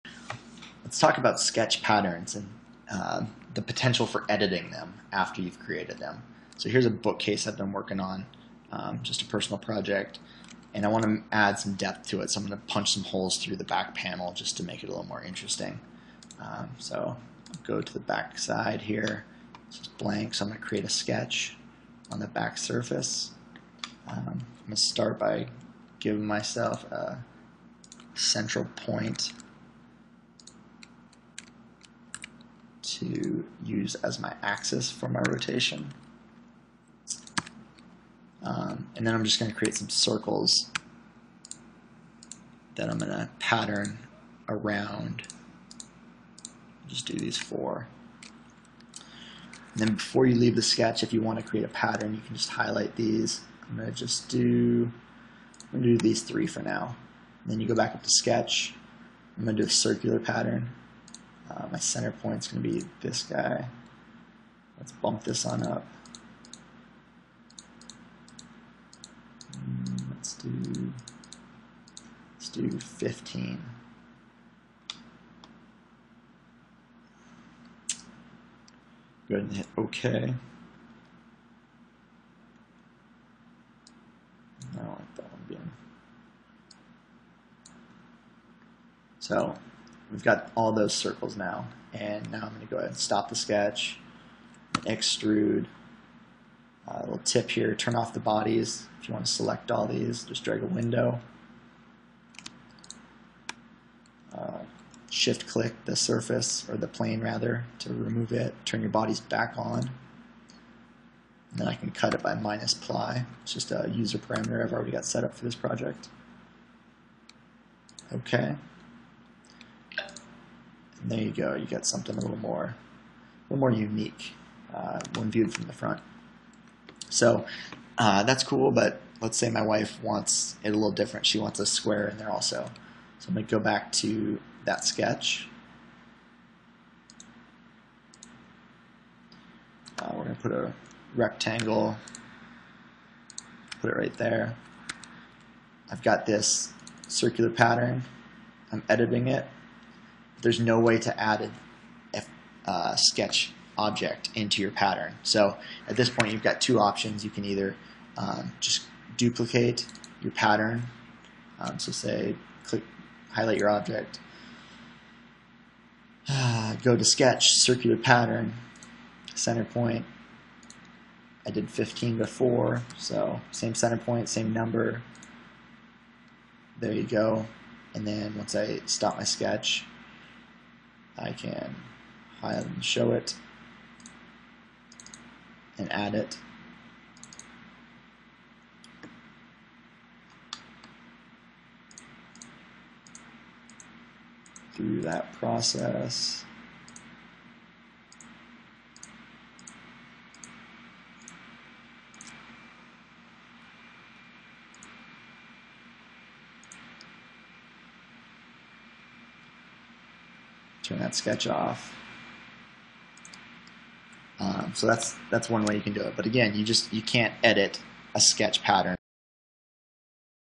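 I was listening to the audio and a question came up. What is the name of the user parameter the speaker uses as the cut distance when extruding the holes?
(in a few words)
minus ply.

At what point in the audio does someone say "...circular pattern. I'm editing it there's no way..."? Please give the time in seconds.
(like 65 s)
147 s.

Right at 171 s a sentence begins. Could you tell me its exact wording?
I did 15 before, so same center point, same number.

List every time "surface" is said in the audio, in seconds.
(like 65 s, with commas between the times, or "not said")
22 s, 105 s.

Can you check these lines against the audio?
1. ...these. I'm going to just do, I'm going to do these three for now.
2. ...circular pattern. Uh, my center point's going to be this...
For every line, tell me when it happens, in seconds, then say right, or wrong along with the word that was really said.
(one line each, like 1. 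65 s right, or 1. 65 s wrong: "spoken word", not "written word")
1. 52 s right
2. 59 s right.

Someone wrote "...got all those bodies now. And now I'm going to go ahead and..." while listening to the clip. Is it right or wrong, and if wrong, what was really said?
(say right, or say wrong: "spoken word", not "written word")
wrong: "circles", not "bodies".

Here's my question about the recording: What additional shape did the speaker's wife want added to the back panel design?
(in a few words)
A square.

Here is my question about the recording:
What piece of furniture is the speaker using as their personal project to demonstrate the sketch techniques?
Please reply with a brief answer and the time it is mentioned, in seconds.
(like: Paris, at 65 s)
Bookcase, at 6 s.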